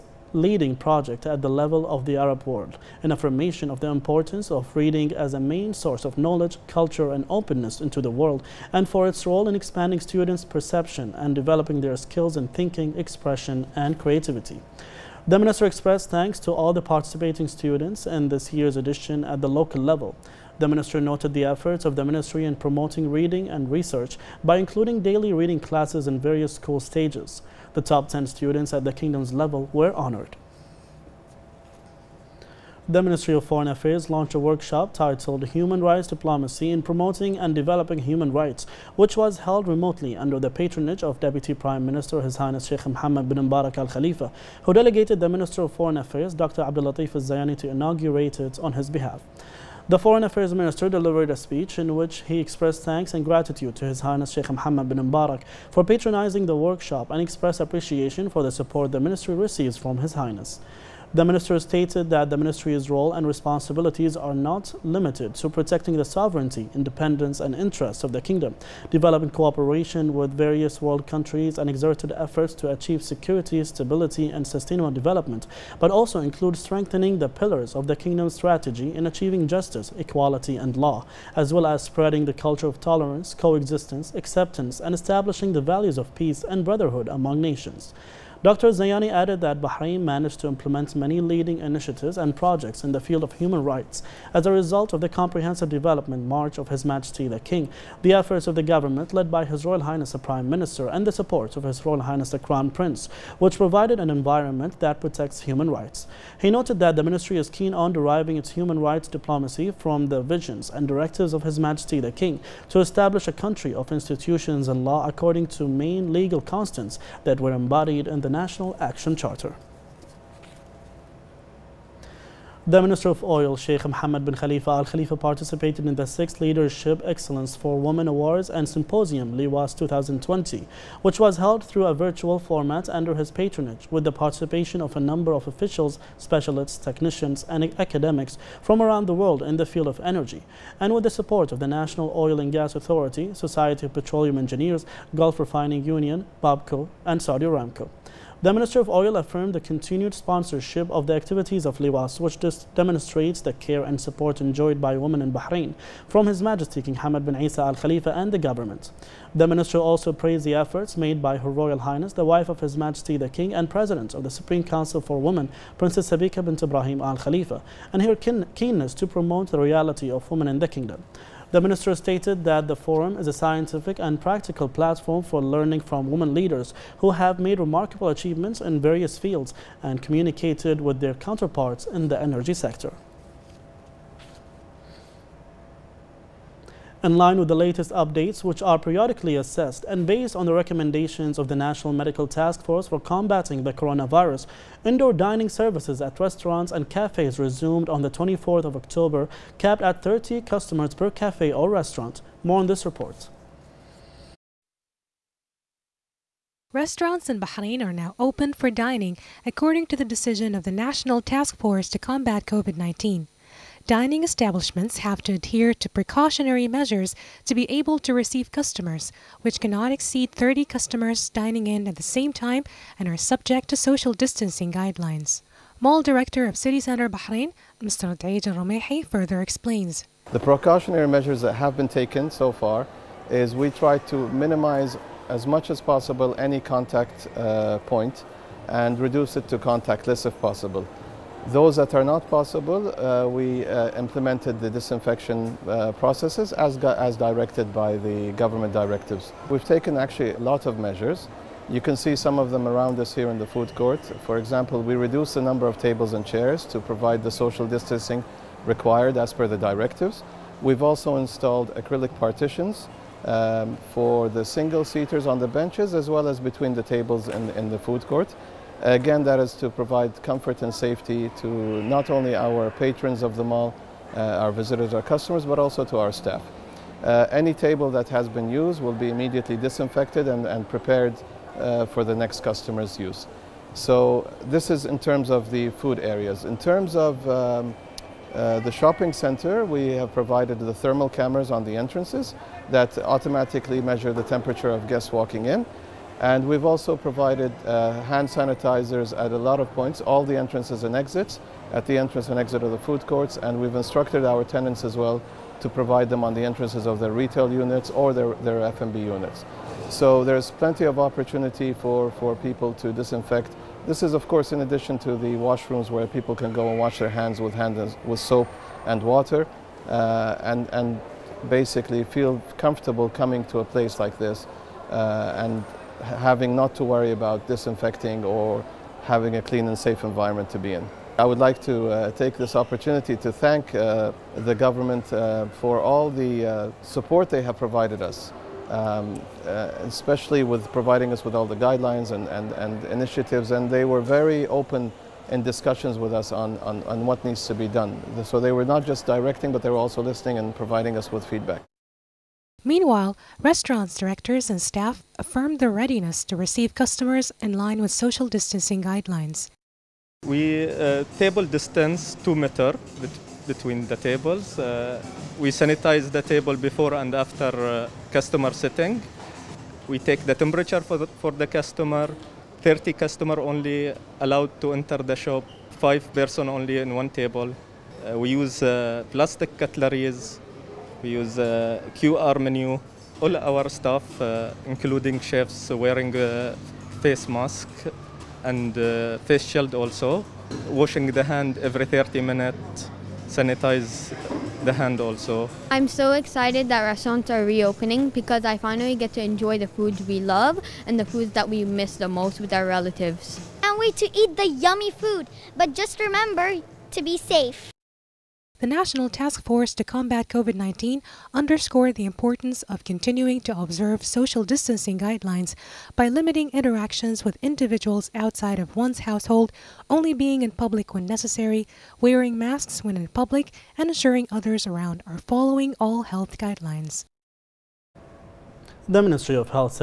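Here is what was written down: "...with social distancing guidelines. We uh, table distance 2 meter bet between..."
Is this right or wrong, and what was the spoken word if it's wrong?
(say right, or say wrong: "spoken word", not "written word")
right.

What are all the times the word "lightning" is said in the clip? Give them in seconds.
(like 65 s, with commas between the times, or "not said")
not said.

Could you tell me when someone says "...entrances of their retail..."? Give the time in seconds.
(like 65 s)
306 s.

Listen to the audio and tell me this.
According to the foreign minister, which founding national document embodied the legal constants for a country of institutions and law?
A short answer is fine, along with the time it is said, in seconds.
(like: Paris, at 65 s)
National Action Charter, at 118 s.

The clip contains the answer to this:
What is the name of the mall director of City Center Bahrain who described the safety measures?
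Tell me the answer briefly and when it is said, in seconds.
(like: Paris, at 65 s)
Daeed Romehi, at 228 s.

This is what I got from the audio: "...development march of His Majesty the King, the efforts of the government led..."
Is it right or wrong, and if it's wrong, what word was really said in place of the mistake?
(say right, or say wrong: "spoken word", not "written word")
right.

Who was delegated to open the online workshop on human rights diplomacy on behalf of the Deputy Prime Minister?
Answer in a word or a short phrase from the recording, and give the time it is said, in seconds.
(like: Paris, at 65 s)
Dr. Abdul Latif Al Zayani, at 46 s.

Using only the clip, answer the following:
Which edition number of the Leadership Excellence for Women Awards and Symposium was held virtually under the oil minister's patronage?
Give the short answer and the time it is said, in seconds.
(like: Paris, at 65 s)
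6th, at 126 s.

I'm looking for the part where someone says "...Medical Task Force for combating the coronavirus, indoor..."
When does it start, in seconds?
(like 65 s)
191 s.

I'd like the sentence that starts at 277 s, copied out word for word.
Uh, any table that has been used will be immediately disinfected and, and prepared uh, for the next customer's use.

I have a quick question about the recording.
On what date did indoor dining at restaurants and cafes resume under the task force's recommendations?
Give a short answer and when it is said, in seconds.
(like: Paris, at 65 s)
24th of October, at 198 s.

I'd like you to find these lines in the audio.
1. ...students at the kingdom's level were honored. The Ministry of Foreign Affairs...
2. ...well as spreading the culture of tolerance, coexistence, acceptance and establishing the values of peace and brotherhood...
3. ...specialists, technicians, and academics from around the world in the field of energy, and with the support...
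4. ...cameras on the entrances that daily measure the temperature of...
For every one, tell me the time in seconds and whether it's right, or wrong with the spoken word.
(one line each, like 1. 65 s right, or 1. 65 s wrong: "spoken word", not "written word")
1. 28 s right
2. 81 s right
3. 136 s right
4. 291 s wrong: "automatically", not "daily".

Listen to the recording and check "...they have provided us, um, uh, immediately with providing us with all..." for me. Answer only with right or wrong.
wrong.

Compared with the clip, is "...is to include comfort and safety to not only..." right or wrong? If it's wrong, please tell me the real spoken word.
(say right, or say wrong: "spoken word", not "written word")
wrong: "provide", not "include".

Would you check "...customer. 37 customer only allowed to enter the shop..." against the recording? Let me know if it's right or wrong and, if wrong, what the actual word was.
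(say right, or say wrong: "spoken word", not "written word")
wrong: "30", not "37".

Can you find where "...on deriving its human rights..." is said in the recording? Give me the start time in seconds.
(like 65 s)
107 s.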